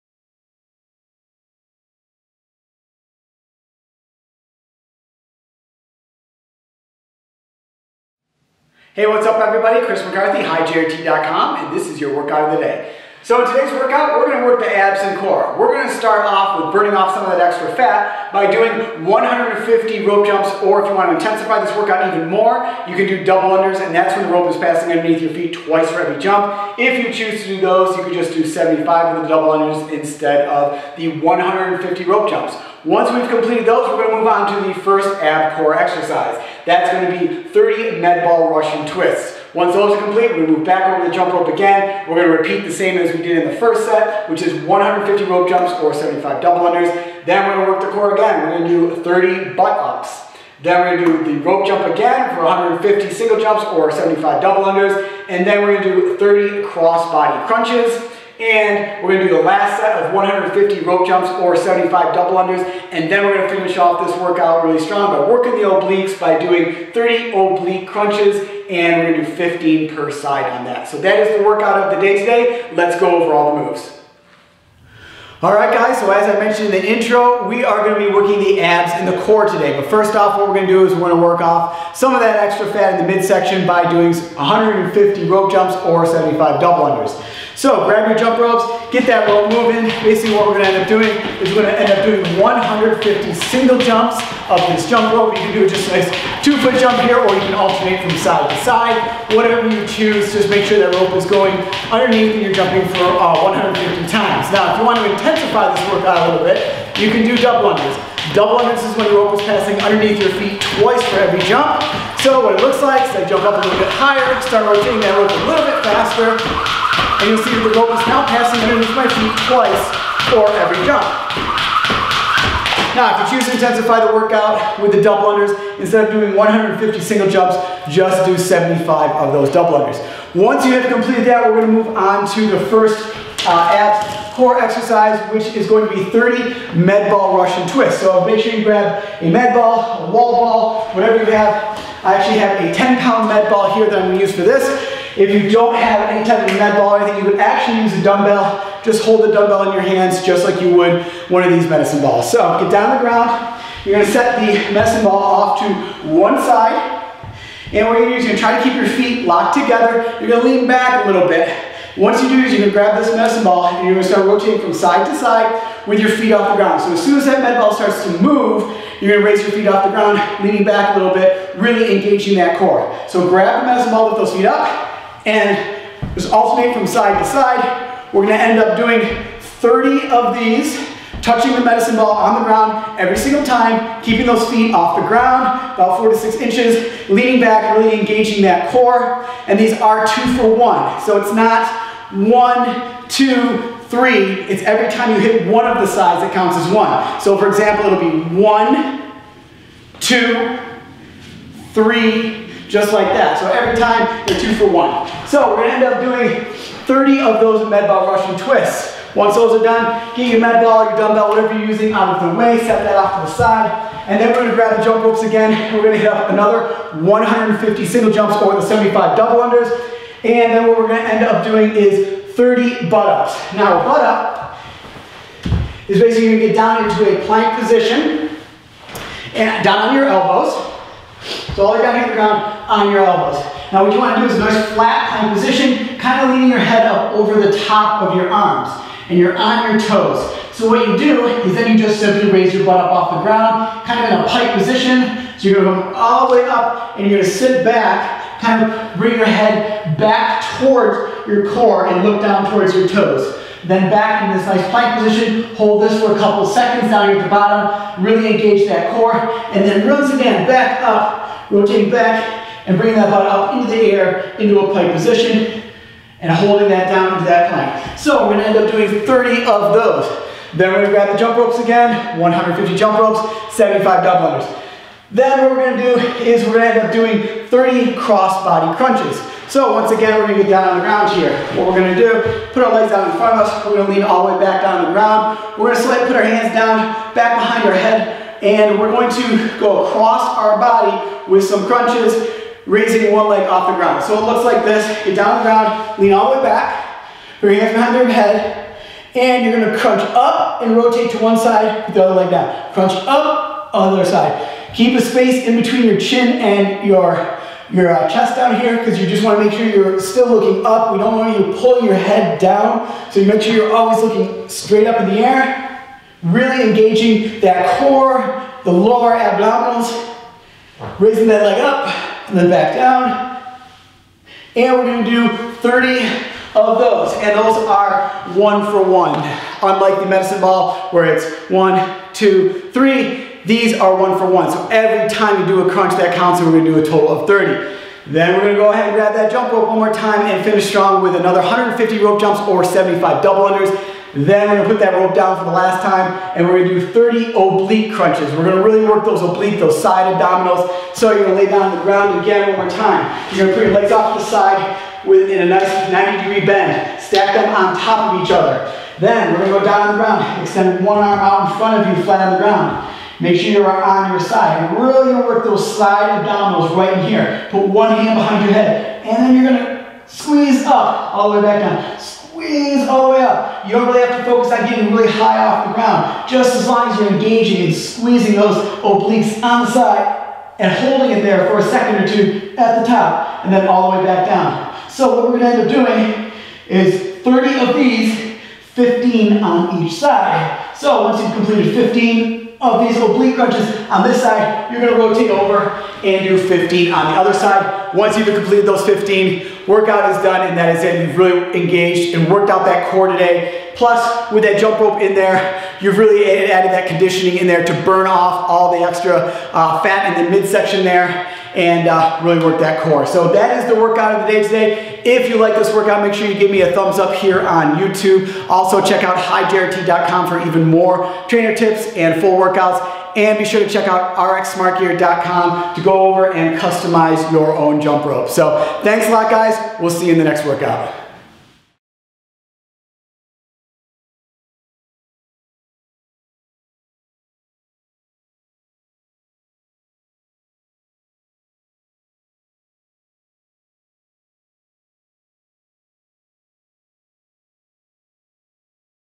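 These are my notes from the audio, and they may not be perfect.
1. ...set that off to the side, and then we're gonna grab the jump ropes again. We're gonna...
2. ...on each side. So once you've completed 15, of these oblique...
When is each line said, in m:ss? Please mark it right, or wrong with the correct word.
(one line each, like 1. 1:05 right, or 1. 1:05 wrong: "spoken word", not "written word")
1. 3:32 right
2. 6:29 right.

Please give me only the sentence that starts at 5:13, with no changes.
So you make sure you're always looking straight up in the air.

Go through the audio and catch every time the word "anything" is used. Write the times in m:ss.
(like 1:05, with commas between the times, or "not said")
2:27.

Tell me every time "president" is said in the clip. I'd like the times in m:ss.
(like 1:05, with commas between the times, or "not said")
not said.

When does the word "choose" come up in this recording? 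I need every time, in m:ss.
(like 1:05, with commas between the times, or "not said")
0:27, 1:39, 2:03.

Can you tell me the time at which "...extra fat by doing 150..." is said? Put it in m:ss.
0:17.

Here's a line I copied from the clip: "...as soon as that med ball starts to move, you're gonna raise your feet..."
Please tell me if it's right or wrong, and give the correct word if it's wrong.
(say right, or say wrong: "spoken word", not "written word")
right.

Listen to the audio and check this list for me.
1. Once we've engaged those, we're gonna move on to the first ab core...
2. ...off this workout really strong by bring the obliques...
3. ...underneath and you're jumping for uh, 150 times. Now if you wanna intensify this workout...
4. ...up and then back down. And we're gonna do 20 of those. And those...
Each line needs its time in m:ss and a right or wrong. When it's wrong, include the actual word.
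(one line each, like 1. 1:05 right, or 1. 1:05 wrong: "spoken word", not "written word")
1. 0:32 wrong: "completed", not "engaged"
2. 1:03 wrong: "working", not "bring"
3. 1:41 right
4. 5:21 wrong: "30", not "20".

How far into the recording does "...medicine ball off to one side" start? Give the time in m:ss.
2:34.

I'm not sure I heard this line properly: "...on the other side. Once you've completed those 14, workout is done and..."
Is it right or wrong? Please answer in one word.
wrong.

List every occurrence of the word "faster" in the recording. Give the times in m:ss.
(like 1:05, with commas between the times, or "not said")
1:55.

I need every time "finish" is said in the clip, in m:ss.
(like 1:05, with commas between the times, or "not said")
1:03, 5:40.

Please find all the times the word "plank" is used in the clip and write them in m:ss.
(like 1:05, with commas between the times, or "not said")
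3:47, 3:55, 4:14, 4:27.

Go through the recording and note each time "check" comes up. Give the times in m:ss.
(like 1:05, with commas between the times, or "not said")
6:58, 7:03.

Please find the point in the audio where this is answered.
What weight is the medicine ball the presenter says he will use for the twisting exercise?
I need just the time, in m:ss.
2:22.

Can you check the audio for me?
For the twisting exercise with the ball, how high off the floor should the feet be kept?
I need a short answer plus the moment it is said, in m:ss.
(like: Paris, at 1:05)
4 to 6 inches, at 3:05.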